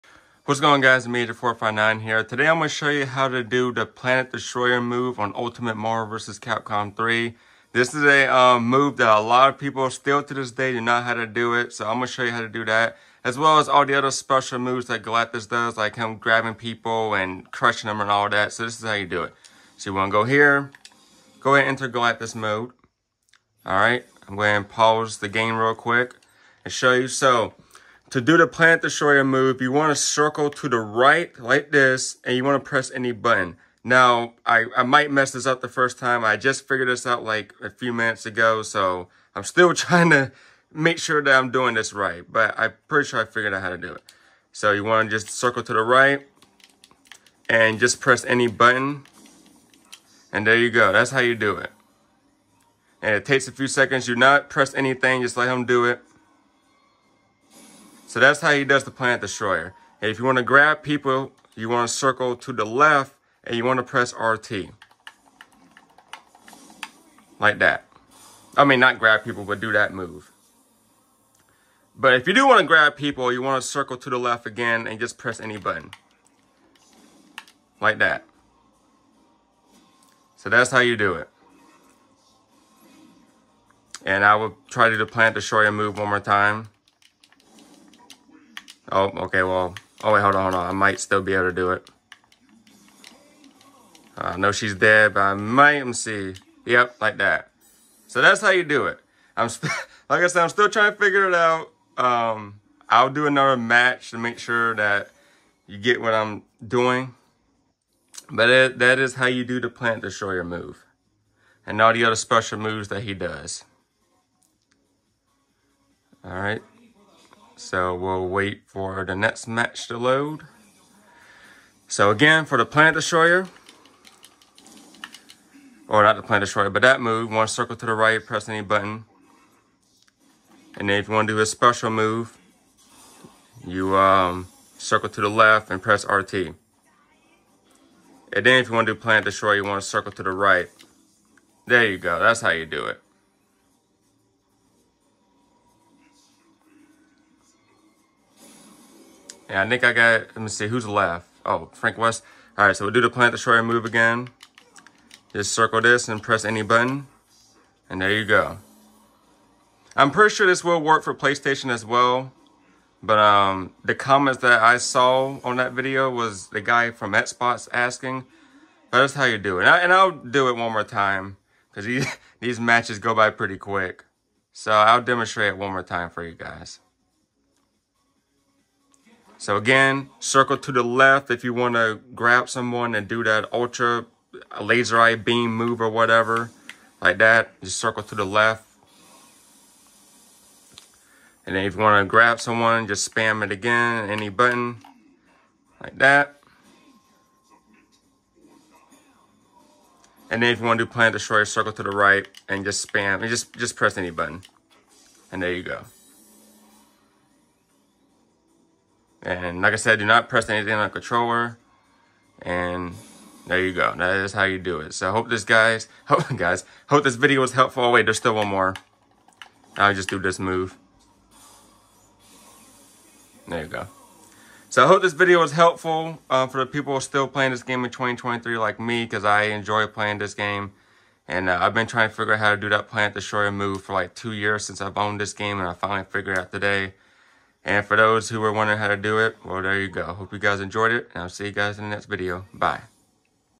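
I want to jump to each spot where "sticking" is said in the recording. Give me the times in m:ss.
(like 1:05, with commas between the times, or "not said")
not said.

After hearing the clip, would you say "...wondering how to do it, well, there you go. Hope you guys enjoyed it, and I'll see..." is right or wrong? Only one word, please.
right.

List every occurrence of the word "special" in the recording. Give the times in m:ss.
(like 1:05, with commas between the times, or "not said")
0:14, 1:52, 2:11.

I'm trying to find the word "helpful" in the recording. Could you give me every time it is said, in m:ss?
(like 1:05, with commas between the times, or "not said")
3:37, 3:45.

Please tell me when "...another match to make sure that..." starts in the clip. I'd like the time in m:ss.
1:43.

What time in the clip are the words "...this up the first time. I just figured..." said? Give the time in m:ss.
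0:35.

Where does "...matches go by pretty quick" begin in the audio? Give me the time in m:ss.
2:52.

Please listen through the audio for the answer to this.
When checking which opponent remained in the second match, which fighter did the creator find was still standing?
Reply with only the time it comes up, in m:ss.
2:31.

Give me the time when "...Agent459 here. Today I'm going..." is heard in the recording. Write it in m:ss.
0:01.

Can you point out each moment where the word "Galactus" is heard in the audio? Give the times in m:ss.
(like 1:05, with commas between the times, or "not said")
0:15, 0:21.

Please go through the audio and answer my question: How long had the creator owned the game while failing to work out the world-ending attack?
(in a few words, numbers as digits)
2 years.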